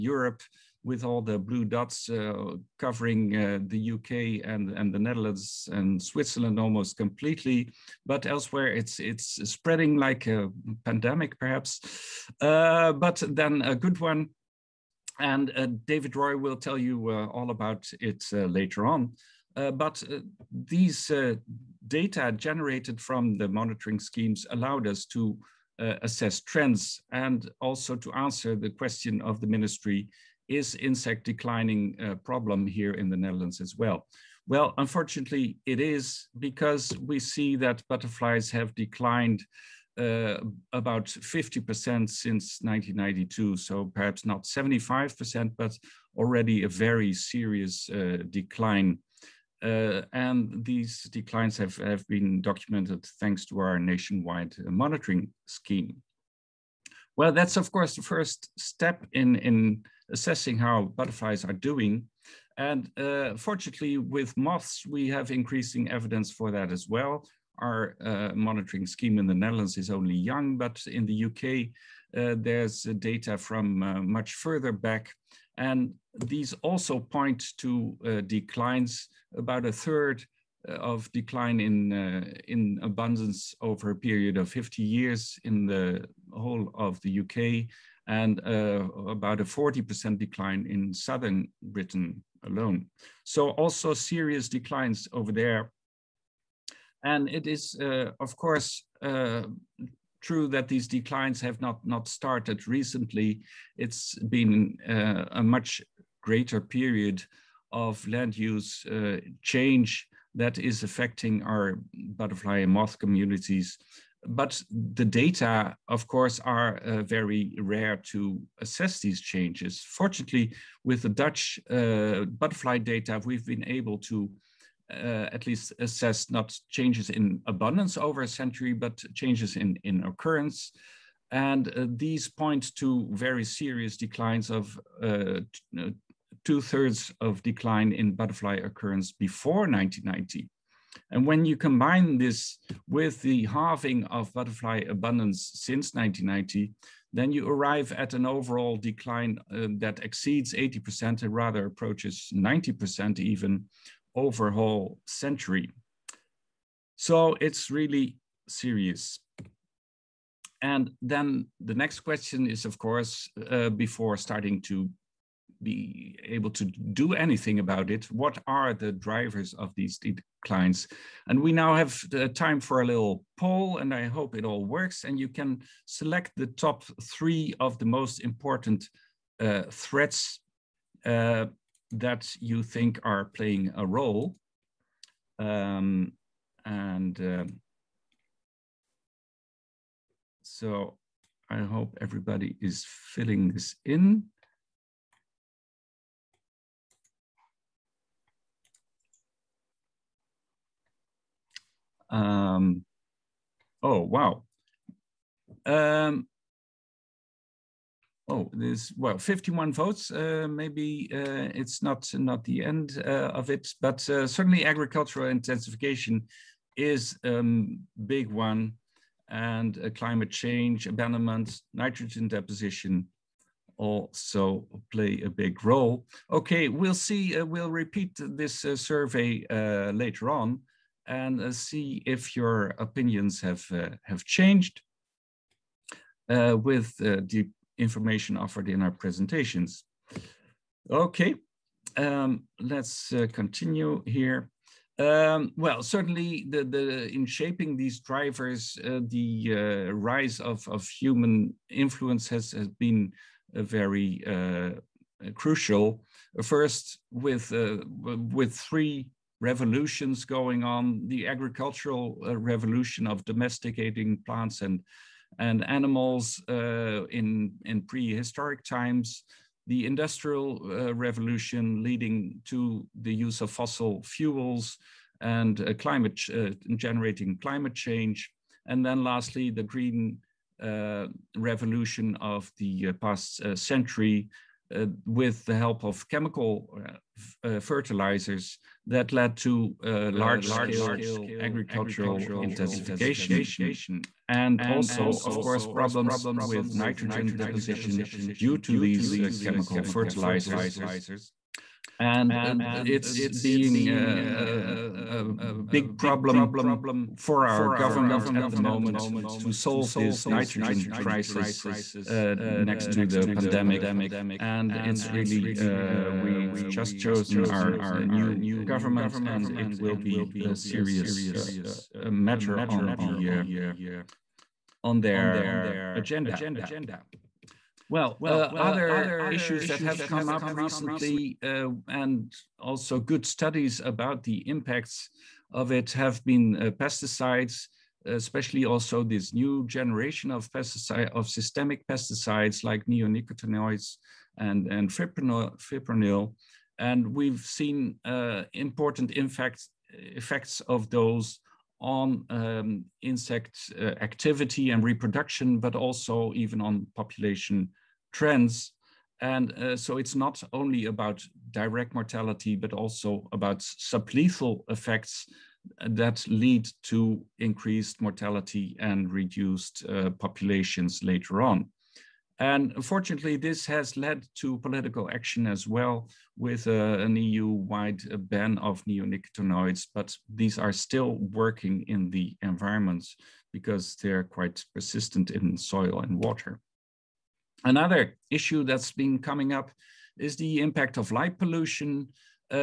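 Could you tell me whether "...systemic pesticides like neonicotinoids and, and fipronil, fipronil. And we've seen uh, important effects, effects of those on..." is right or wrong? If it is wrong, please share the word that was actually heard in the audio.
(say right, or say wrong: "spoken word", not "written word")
right.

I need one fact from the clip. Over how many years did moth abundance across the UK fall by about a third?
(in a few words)
50 years.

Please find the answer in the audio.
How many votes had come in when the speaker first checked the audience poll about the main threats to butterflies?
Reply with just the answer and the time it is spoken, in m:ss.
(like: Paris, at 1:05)
51, at 3:29.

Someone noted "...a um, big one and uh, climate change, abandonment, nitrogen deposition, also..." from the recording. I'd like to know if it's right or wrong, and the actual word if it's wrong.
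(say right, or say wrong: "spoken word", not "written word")
right.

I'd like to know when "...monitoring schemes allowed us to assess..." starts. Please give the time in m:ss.
0:23.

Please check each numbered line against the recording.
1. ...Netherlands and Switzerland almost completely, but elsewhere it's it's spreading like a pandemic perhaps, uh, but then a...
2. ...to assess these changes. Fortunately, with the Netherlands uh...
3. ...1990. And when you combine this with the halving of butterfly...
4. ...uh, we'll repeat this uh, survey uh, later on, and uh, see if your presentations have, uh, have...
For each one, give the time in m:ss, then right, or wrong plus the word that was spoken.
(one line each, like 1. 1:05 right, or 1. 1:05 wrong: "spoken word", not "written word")
1. 0:04 right
2. 1:58 wrong: "Dutch", not "Netherlands"
3. 2:19 right
4. 3:47 wrong: "opinions", not "presentations".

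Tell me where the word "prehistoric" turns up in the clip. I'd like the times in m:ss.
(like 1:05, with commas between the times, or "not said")
4:27.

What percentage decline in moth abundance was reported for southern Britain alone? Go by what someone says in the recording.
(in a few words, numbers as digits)
40%.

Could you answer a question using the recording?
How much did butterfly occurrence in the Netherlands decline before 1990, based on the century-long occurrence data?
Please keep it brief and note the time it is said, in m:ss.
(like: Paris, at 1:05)
two thirds, at 2:16.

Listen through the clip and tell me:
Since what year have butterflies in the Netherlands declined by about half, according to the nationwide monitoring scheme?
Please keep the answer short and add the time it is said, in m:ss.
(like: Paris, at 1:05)
1992, at 0:42.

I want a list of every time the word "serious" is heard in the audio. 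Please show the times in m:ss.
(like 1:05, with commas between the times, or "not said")
0:47, 1:33, 2:13, 2:38, 5:20.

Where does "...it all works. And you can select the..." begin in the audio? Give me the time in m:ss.
2:54.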